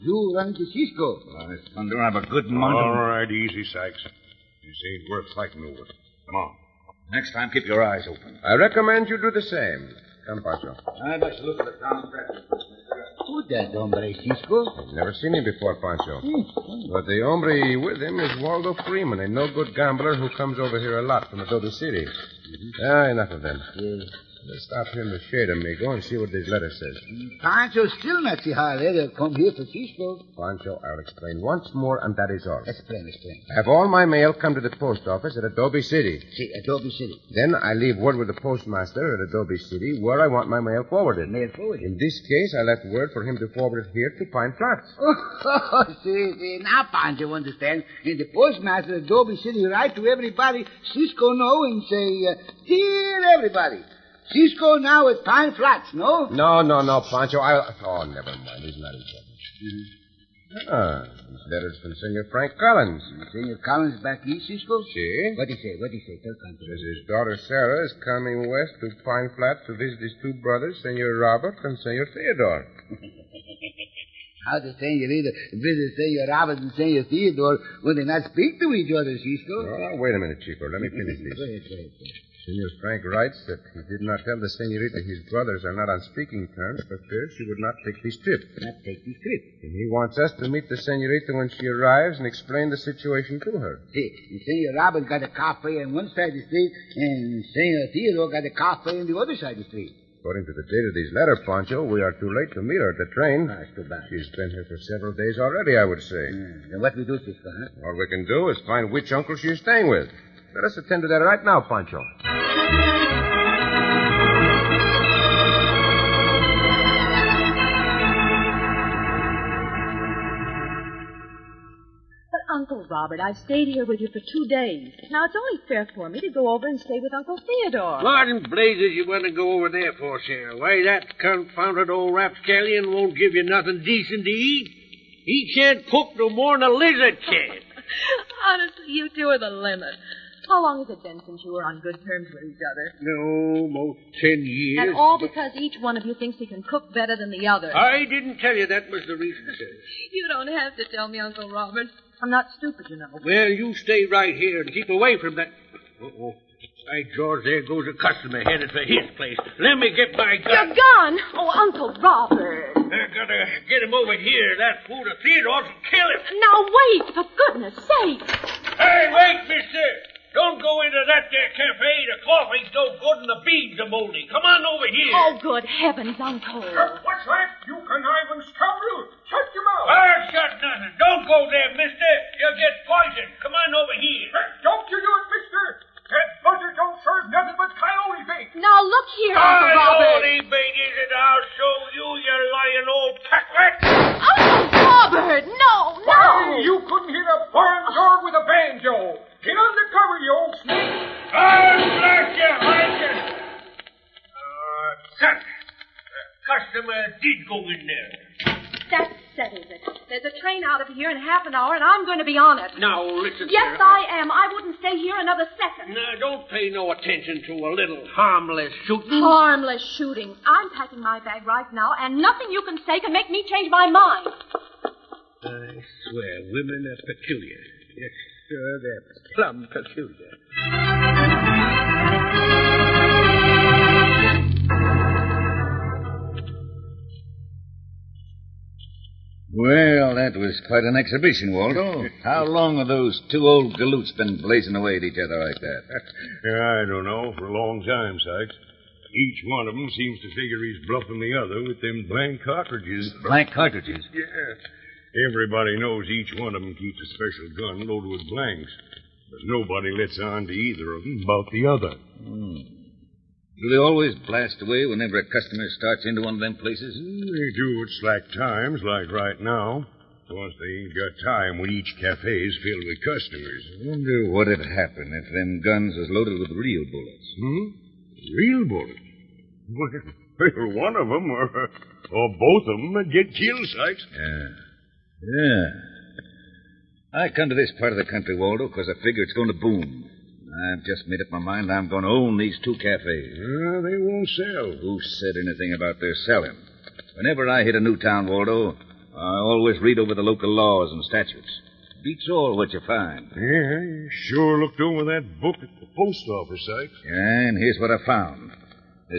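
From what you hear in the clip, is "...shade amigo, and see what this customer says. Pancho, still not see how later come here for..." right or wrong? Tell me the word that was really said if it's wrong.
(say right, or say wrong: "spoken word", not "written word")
wrong: "letter", not "customer".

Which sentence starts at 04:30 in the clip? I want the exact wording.
Of course, they ain't got time when each cafe's filled with customers.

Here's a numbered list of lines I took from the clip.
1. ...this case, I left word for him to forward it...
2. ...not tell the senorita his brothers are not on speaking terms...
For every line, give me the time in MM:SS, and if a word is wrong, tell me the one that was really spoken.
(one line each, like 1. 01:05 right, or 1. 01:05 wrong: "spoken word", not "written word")
1. 00:41 right
2. 01:23 right.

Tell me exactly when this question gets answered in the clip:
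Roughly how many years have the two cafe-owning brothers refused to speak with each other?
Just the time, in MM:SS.
02:24.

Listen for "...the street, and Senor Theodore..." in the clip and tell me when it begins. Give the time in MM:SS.
01:36.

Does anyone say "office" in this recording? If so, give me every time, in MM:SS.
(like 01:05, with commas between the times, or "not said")
00:35, 05:06.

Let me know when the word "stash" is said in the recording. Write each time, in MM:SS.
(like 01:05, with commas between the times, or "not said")
not said.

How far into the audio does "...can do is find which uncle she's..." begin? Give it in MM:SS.
01:48.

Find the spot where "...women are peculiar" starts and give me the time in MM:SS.
03:46.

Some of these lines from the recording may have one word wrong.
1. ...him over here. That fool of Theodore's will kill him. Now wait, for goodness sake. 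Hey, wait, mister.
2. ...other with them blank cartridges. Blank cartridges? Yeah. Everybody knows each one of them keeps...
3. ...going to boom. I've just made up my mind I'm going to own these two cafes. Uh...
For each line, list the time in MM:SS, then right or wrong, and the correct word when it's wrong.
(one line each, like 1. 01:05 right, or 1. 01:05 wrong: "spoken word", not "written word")
1. 02:43 right
2. 04:11 right
3. 04:49 right.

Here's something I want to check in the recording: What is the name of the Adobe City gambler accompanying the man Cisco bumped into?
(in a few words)
Waldo Freeman.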